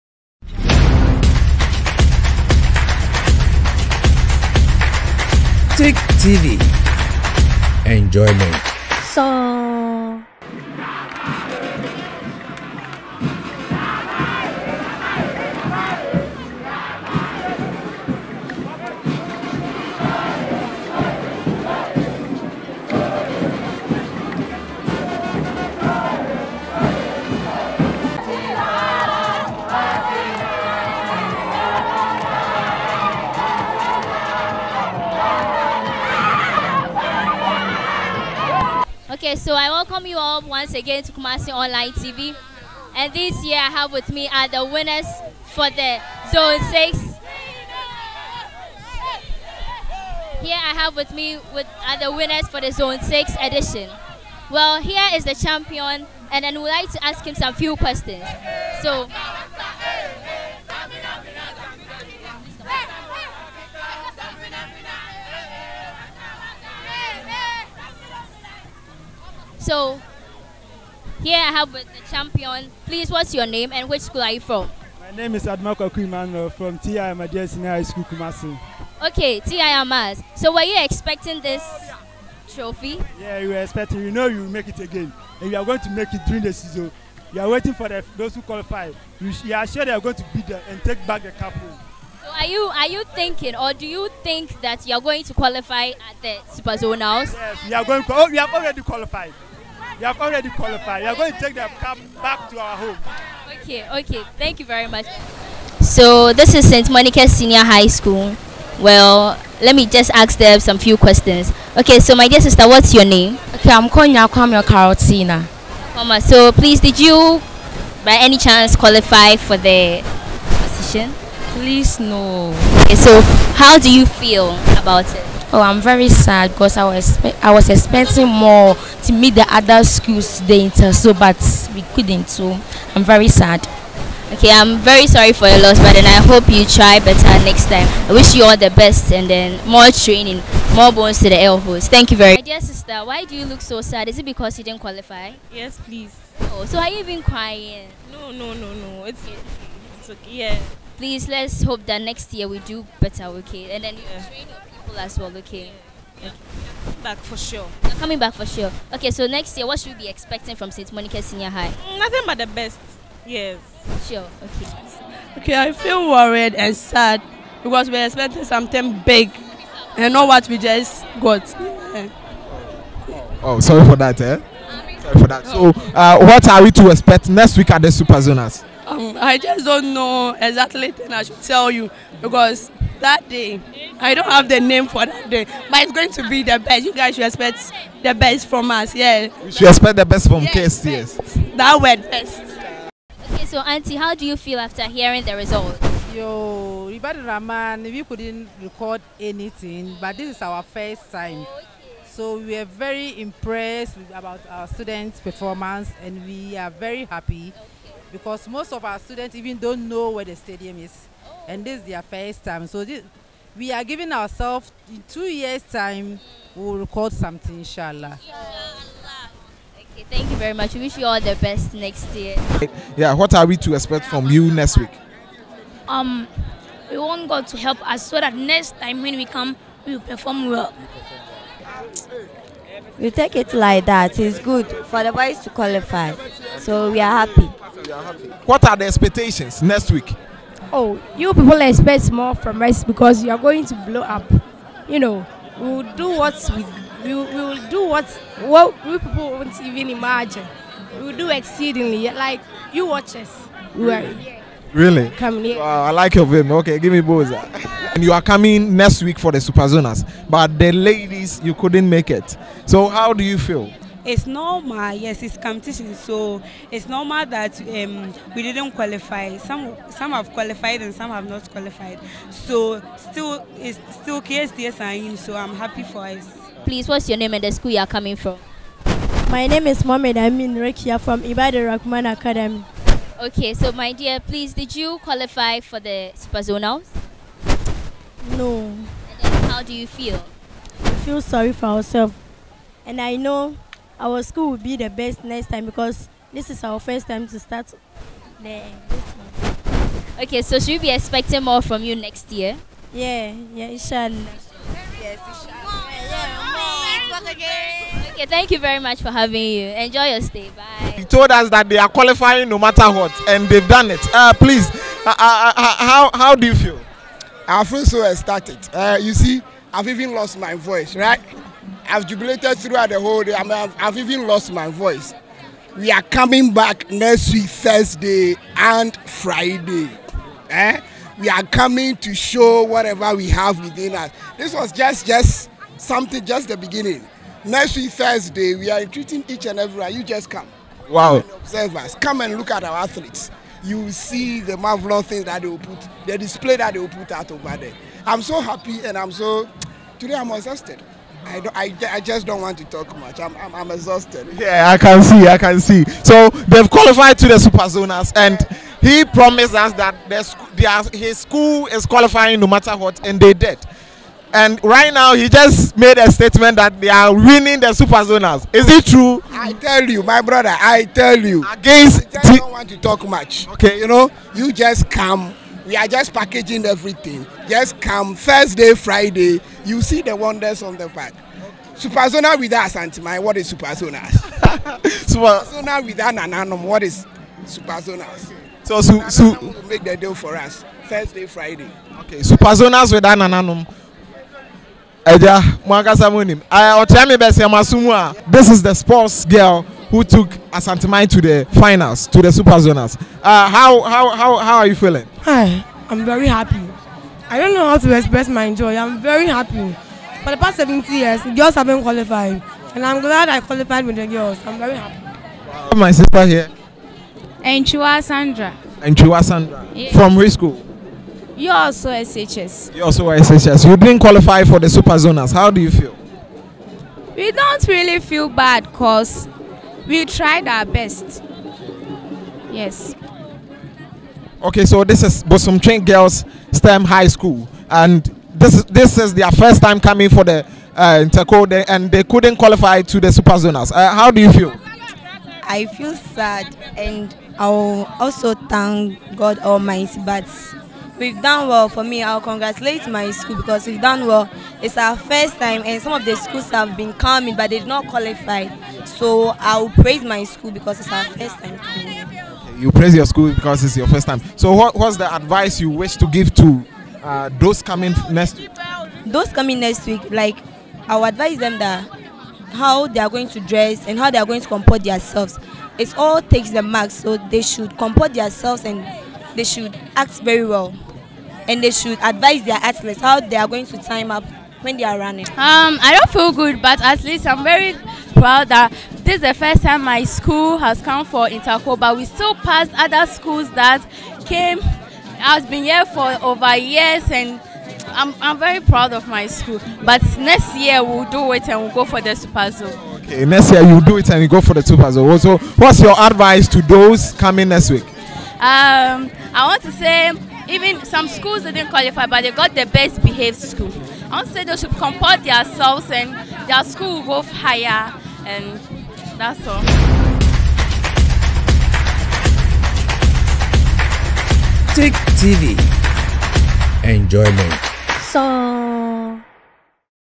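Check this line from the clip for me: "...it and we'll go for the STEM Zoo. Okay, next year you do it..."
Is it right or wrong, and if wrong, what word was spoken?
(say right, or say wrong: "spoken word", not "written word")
wrong: "Super", not "STEM".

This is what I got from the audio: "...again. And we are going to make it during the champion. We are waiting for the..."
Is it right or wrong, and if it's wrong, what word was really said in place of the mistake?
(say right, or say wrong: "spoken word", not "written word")
wrong: "season", not "champion".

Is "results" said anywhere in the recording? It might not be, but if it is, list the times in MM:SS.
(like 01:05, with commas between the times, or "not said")
03:15.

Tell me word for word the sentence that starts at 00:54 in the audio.
Well, here is the champion, and I would like to ask him some few questions.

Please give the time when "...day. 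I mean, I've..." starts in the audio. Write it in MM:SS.
05:23.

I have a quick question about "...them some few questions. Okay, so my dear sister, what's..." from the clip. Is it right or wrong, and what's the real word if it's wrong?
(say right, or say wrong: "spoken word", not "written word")
right.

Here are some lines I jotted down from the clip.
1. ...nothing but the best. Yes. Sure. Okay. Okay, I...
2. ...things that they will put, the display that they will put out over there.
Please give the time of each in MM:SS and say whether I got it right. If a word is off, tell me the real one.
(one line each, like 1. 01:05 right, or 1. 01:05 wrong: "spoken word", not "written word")
1. 02:41 right
2. 05:45 right.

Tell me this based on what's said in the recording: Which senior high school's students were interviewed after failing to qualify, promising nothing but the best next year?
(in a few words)
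St. Monica Senior High School.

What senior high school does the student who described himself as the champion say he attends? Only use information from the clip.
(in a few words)
TI Amadia Senior High School.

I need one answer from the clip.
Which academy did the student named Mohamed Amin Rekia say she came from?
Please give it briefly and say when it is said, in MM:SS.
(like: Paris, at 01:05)
Ibadan Rahman Academy, at 04:41.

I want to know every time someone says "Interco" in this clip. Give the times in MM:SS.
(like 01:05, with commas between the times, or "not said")
07:21, 08:11.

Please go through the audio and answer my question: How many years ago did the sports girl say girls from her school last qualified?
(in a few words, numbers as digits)
70 years.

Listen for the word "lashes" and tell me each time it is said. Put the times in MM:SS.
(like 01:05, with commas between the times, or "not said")
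not said.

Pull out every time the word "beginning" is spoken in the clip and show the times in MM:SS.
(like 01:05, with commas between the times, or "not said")
05:36.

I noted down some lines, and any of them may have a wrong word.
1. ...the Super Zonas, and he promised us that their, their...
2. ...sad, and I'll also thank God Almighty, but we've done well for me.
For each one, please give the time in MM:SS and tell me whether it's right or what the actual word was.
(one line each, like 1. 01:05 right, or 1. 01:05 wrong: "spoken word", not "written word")
1. 05:57 right
2. 07:25 right.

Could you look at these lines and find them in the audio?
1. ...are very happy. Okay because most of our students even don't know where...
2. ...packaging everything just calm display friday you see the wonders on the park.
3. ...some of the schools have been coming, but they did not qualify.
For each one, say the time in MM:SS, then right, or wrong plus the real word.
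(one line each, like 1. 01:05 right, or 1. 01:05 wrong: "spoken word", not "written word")
1. 03:26 right
2. 06:16 wrong: "thursday", not "display"
3. 07:35 right.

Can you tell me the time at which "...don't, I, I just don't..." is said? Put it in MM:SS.
05:51.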